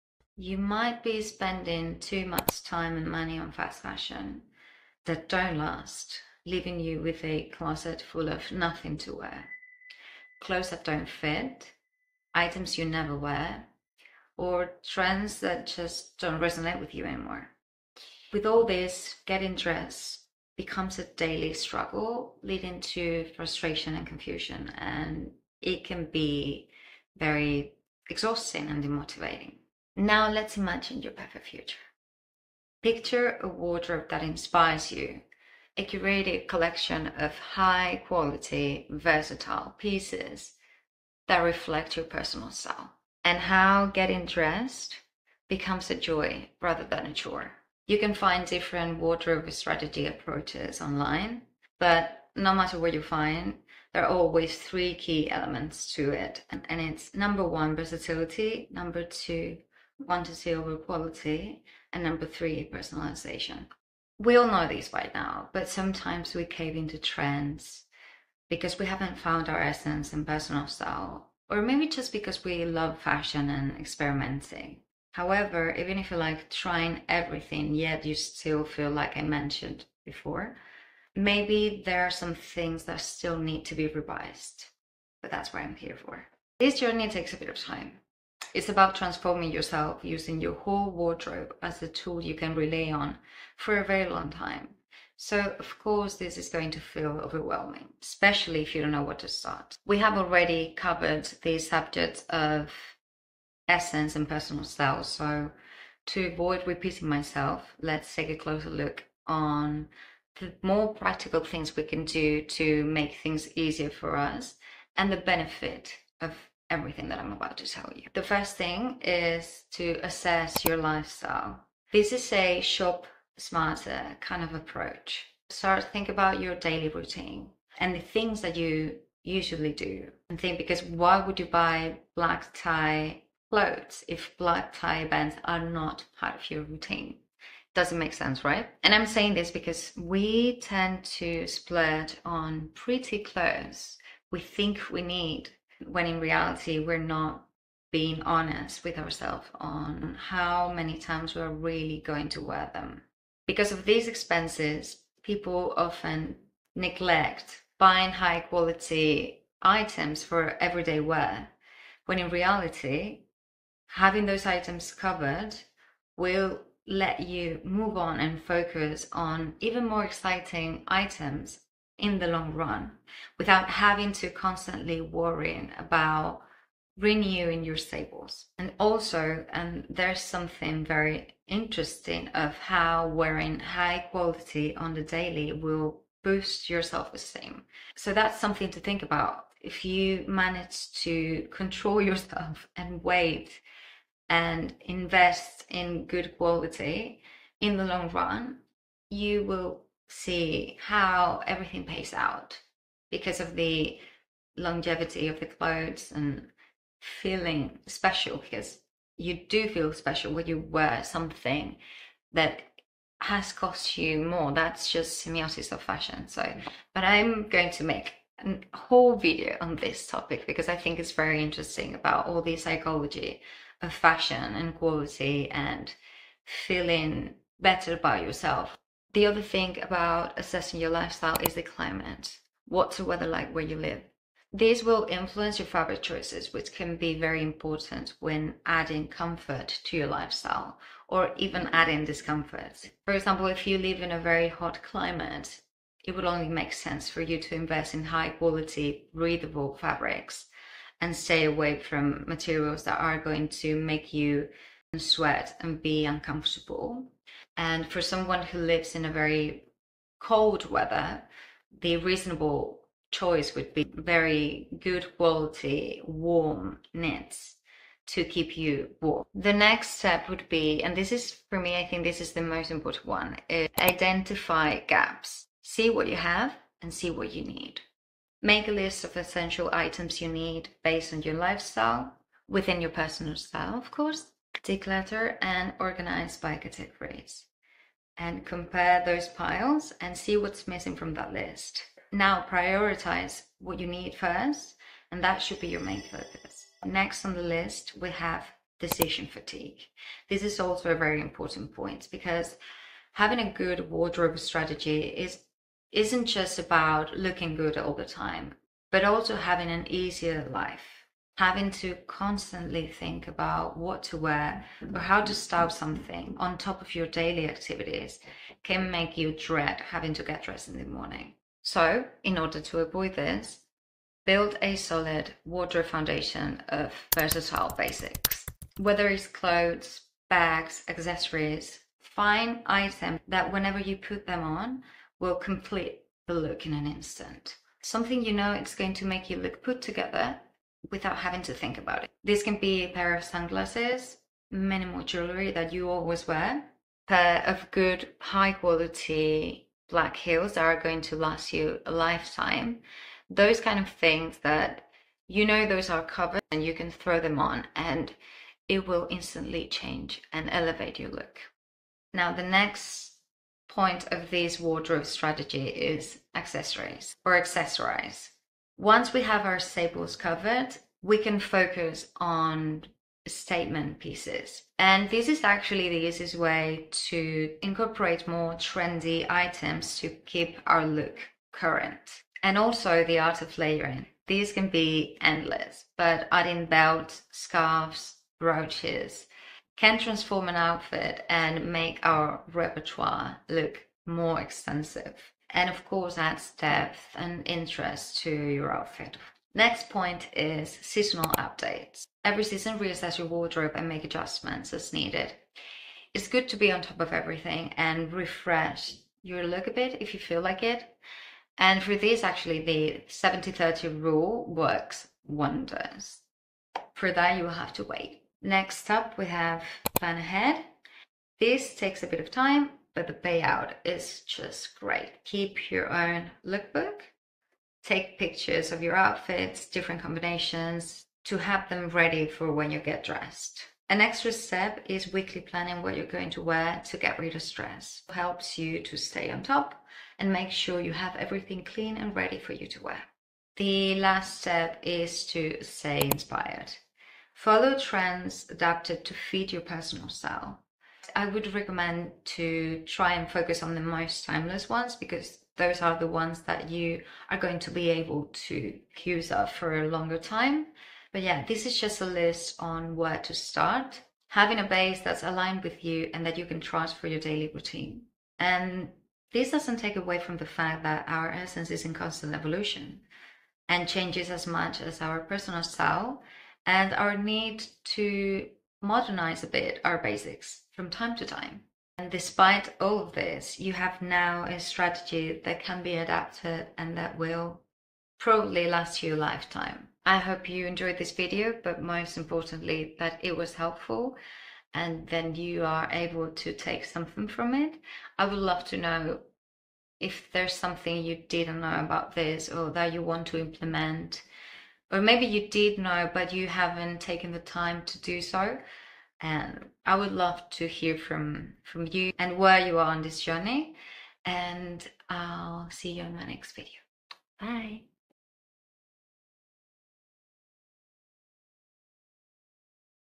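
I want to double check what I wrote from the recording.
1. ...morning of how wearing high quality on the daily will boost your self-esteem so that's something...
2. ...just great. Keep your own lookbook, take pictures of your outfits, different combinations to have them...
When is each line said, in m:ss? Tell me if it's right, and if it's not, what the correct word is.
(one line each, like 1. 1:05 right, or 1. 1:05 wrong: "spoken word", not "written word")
1. 3:01 wrong: "interesting", not "morning"
2. 7:04 right.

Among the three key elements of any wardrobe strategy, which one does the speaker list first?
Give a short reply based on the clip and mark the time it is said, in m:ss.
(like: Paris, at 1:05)
Versatility, at 0:57.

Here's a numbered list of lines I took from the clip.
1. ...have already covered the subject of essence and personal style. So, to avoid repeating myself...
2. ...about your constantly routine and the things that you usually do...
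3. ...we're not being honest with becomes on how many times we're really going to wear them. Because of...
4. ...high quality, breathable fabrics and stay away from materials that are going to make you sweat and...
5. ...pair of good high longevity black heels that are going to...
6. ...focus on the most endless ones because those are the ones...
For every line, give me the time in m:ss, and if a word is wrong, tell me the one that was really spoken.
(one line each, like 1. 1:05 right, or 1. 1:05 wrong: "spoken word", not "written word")
1. 1:39 right
2. 2:06 wrong: "daily", not "constantly"
3. 2:26 wrong: "ourselves", not "becomes"
4. 4:08 right
5. 5:47 wrong: "quality", not "longevity"
6. 7:33 wrong: "timeless", not "endless".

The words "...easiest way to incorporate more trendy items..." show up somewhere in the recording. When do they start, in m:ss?
6:16.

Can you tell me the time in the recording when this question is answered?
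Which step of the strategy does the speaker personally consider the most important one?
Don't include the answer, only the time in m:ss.
4:33.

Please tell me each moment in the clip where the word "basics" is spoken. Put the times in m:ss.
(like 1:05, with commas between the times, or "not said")
5:27, 7:59.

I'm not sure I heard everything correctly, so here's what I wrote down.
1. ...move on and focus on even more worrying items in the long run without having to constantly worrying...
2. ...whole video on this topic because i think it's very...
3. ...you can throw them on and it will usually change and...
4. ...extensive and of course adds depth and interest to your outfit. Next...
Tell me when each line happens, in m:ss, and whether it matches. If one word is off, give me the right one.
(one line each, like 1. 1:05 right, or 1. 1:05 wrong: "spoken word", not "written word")
1. 2:47 wrong: "exciting", not "worrying"
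2. 3:38 right
3. 5:56 wrong: "instantly", not "usually"
4. 6:34 right.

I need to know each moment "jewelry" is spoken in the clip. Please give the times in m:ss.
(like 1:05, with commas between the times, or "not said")
5:45.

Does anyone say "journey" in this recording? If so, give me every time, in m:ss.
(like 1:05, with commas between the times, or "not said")
1:26, 8:33.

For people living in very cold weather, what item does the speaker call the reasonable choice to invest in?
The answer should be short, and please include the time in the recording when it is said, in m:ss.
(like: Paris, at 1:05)
Warm knits, at 4:26.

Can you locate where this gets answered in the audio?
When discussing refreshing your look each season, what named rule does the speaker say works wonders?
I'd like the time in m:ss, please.
6:53.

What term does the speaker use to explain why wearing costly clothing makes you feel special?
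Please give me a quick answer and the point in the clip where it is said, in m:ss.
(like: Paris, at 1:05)
Semiosis of fashion, at 3:35.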